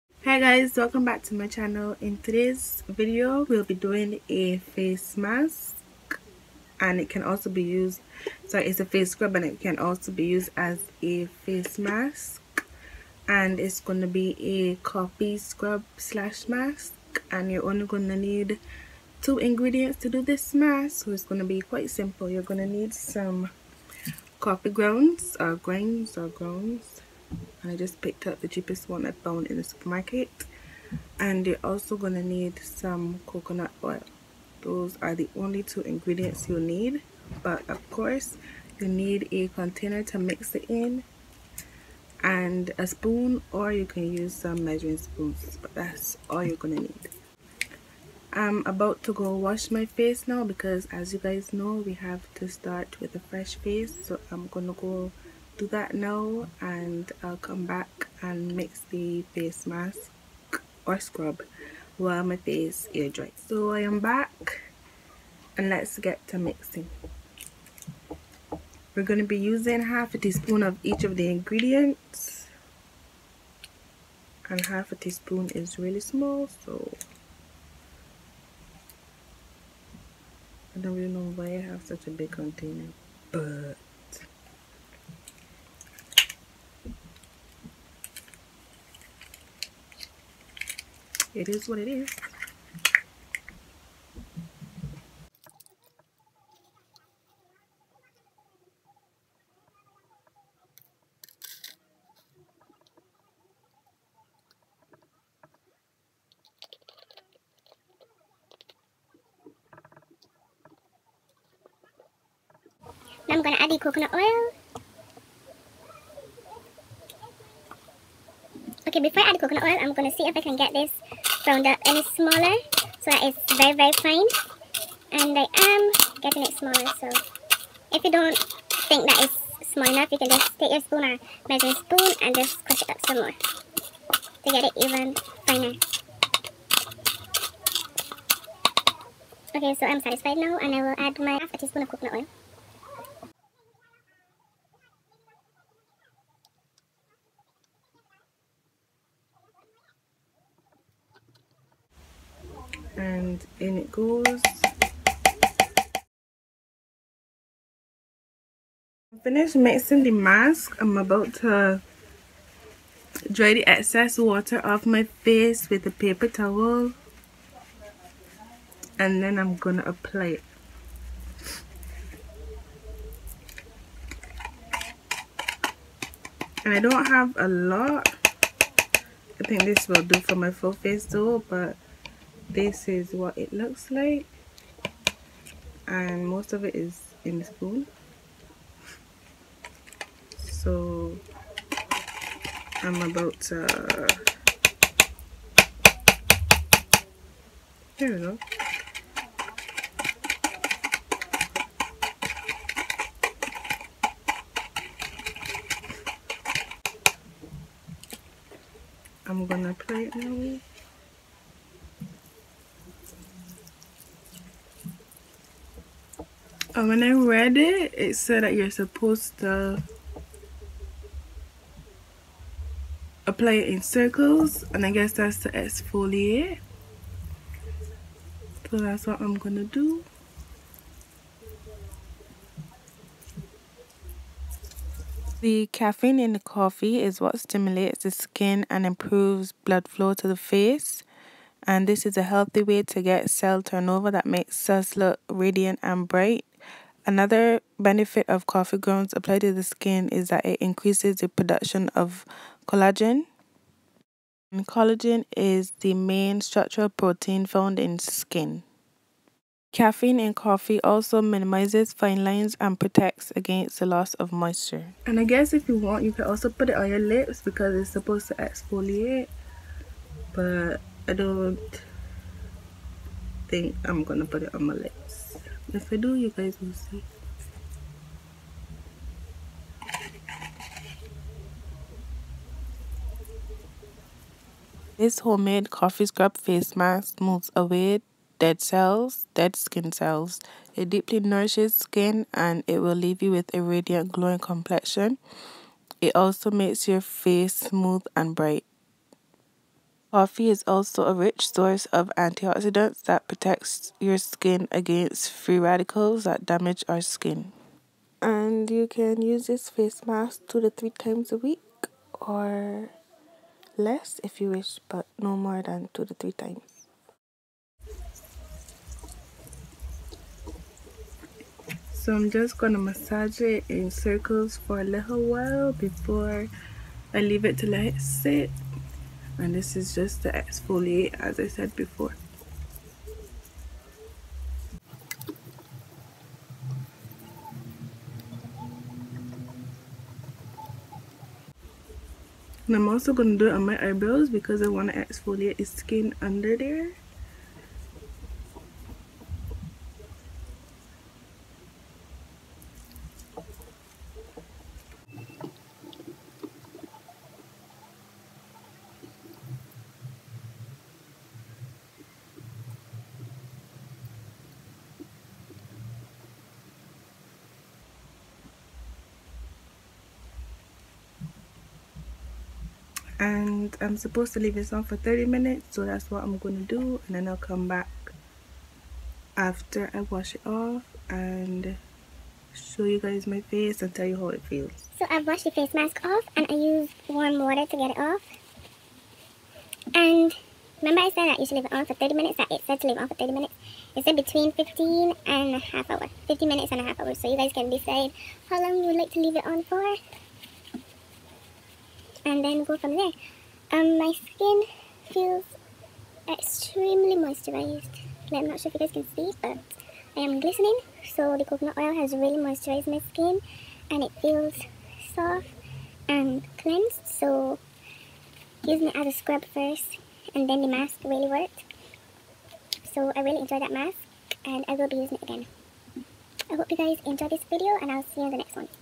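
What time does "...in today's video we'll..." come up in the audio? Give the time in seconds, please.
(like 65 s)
2 s.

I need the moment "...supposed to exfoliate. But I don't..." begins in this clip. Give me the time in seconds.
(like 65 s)
267 s.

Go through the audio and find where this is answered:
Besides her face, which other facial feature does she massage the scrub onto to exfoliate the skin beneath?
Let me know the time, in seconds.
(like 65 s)
343 s.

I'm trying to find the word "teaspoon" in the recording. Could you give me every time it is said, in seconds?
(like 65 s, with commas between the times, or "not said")
70 s, 74 s, 141 s.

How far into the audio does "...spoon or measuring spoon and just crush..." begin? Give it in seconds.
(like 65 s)
130 s.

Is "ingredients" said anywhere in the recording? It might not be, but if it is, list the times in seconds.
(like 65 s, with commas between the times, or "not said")
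19 s, 35 s, 71 s.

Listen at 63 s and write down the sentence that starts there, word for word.
So I am back and let's get to mixing.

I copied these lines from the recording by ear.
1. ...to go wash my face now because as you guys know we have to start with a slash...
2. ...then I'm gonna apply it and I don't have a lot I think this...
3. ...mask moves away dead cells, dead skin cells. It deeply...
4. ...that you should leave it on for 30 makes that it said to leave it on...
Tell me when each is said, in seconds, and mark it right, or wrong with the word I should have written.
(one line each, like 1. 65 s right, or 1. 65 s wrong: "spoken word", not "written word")
1. 49 s wrong: "fresh", not "slash"
2. 169 s right
3. 286 s right
4. 391 s wrong: "minutes", not "makes".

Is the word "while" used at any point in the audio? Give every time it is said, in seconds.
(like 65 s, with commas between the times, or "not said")
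61 s, 325 s.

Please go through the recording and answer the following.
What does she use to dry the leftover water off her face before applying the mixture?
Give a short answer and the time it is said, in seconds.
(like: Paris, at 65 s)
a paper towel, at 165 s.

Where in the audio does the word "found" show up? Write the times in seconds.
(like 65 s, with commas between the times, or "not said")
29 s, 257 s.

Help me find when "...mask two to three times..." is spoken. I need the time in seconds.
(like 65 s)
310 s.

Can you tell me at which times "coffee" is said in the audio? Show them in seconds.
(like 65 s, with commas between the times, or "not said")
14 s, 24 s, 236 s, 248 s, 260 s, 285 s, 300 s.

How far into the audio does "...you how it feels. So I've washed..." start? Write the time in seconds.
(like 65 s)
384 s.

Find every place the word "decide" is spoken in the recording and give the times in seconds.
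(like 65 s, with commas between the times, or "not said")
397 s.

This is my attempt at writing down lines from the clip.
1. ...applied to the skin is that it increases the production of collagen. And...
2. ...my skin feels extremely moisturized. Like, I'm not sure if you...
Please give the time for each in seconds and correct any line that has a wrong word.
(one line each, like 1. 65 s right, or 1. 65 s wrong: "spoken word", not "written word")
1. 249 s right
2. 403 s right.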